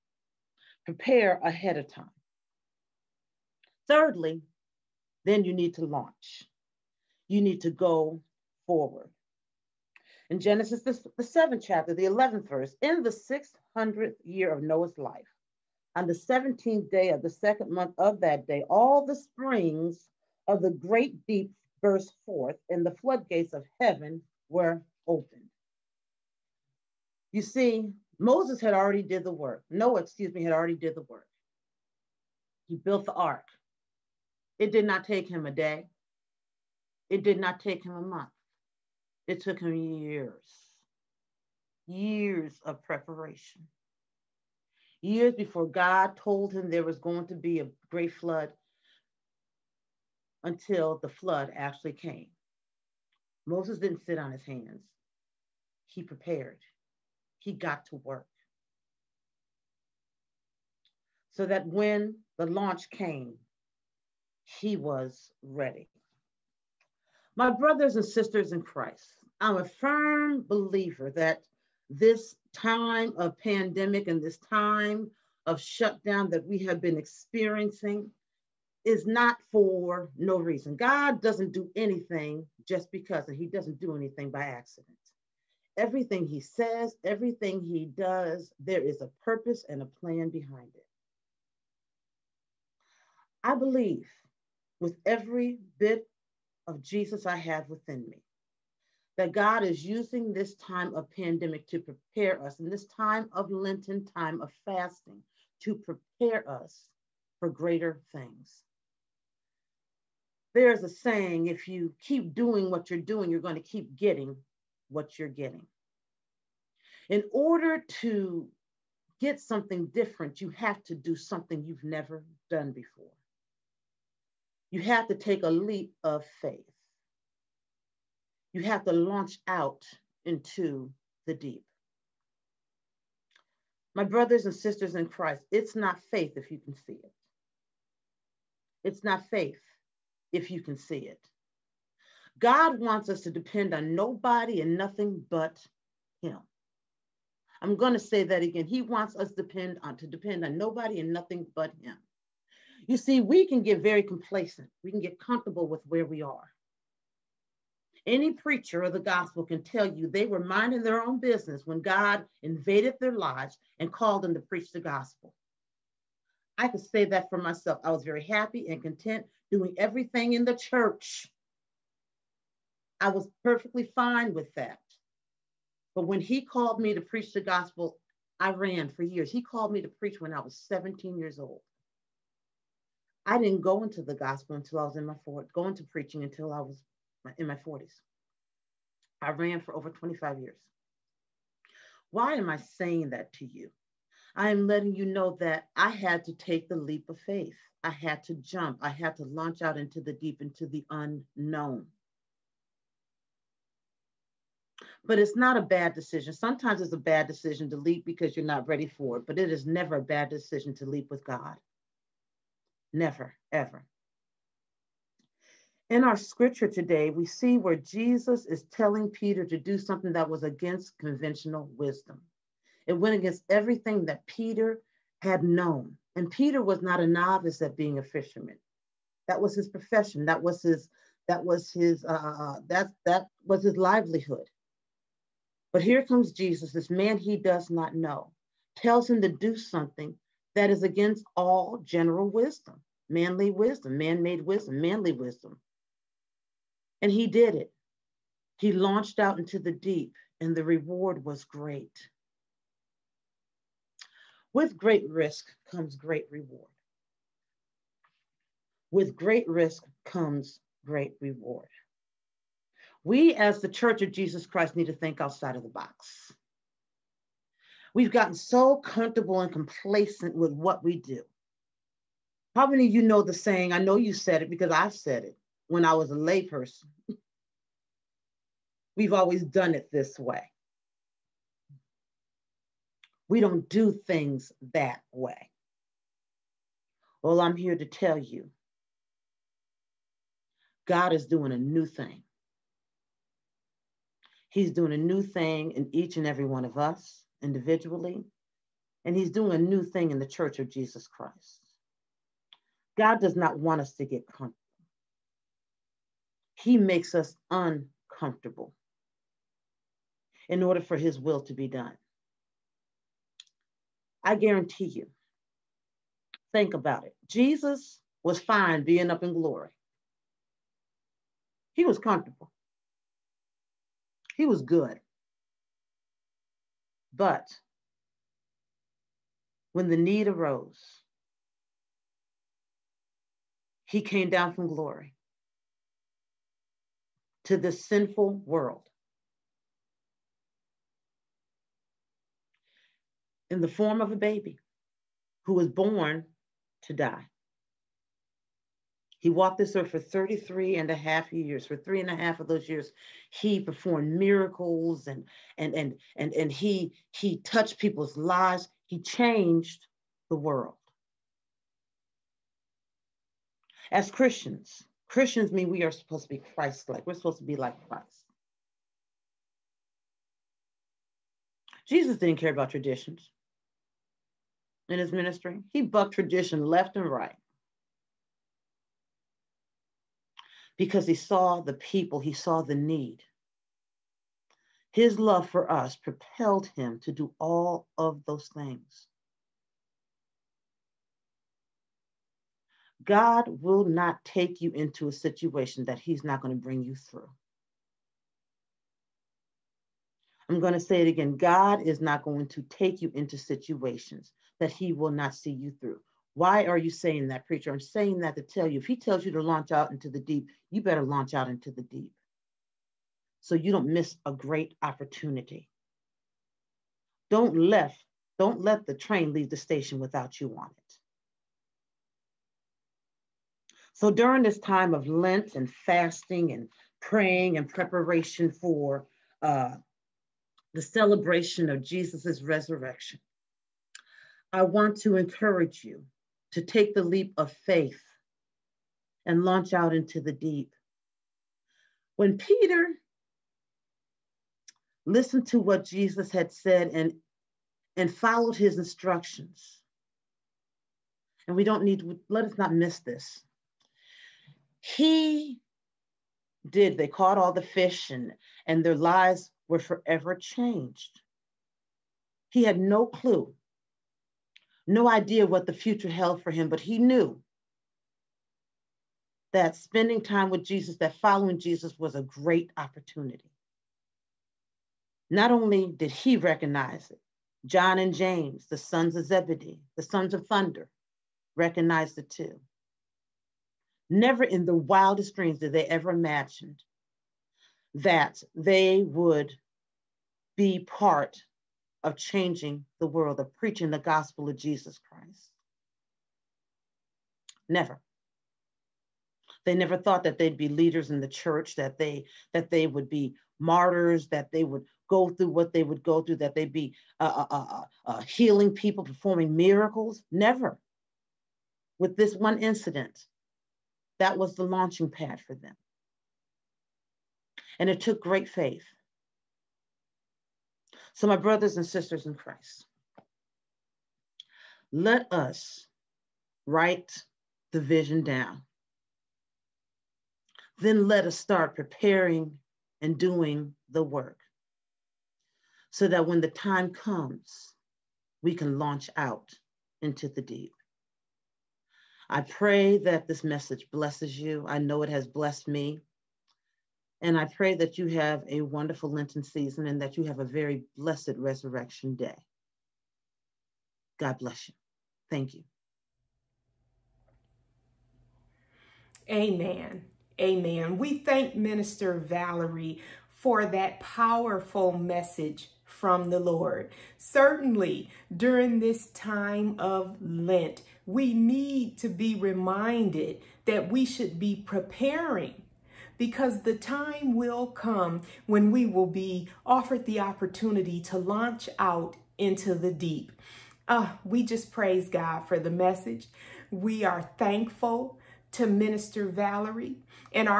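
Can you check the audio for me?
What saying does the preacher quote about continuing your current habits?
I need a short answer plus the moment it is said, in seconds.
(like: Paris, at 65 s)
You're going to keep getting what you're getting, at 113 s.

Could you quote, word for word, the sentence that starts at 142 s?
God wants us to depend on nobody and nothing but Him.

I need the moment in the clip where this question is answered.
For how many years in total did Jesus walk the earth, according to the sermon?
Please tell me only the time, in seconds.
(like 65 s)
350 s.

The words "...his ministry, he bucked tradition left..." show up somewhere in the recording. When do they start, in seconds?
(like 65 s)
374 s.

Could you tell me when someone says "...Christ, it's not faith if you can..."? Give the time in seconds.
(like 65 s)
135 s.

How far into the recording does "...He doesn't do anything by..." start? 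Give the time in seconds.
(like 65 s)
83 s.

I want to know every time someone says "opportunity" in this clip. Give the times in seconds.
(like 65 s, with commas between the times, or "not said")
414 s, 472 s, 580 s.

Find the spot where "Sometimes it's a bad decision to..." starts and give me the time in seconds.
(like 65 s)
206 s.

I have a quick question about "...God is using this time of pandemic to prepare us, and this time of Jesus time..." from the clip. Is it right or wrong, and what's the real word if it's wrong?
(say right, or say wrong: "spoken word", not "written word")
wrong: "Lenten", not "Jesus".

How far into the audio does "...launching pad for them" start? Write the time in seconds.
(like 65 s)
514 s.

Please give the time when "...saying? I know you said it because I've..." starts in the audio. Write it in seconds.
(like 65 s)
273 s.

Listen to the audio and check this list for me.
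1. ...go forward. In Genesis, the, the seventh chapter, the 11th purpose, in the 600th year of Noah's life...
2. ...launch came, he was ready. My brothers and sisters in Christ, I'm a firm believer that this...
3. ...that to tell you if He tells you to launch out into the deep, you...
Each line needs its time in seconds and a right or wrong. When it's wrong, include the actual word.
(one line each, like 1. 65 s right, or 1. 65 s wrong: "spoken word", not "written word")
1. 7 s wrong: "verse", not "purpose"
2. 62 s right
3. 408 s right.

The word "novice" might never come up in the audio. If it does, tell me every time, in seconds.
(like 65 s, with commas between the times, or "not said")
227 s.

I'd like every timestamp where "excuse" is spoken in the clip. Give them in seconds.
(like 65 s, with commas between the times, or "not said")
30 s.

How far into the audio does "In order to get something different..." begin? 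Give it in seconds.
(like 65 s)
117 s.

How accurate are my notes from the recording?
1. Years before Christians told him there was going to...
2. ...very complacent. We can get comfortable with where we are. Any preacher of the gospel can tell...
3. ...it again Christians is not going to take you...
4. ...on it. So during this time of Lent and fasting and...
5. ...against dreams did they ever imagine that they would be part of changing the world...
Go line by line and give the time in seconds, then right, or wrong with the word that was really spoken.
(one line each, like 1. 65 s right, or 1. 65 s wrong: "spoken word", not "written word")
1. 45 s wrong: "God", not "Christians"
2. 153 s right
3. 401 s wrong: "God", not "Christians"
4. 420 s right
5. 484 s wrong: "wildest", not "against".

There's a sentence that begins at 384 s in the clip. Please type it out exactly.
His love for us propelled him to do all of those things.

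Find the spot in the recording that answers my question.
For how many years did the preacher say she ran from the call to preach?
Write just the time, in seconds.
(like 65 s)
189 s.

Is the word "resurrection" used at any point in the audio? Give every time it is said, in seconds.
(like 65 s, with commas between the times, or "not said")
432 s, 551 s.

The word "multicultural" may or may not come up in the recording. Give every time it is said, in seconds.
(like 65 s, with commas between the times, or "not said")
not said.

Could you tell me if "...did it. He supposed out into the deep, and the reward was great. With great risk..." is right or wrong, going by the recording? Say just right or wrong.
wrong.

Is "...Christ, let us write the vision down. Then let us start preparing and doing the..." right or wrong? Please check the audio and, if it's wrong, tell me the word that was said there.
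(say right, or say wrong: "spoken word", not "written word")
right.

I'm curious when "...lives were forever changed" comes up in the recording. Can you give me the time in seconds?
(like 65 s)
458 s.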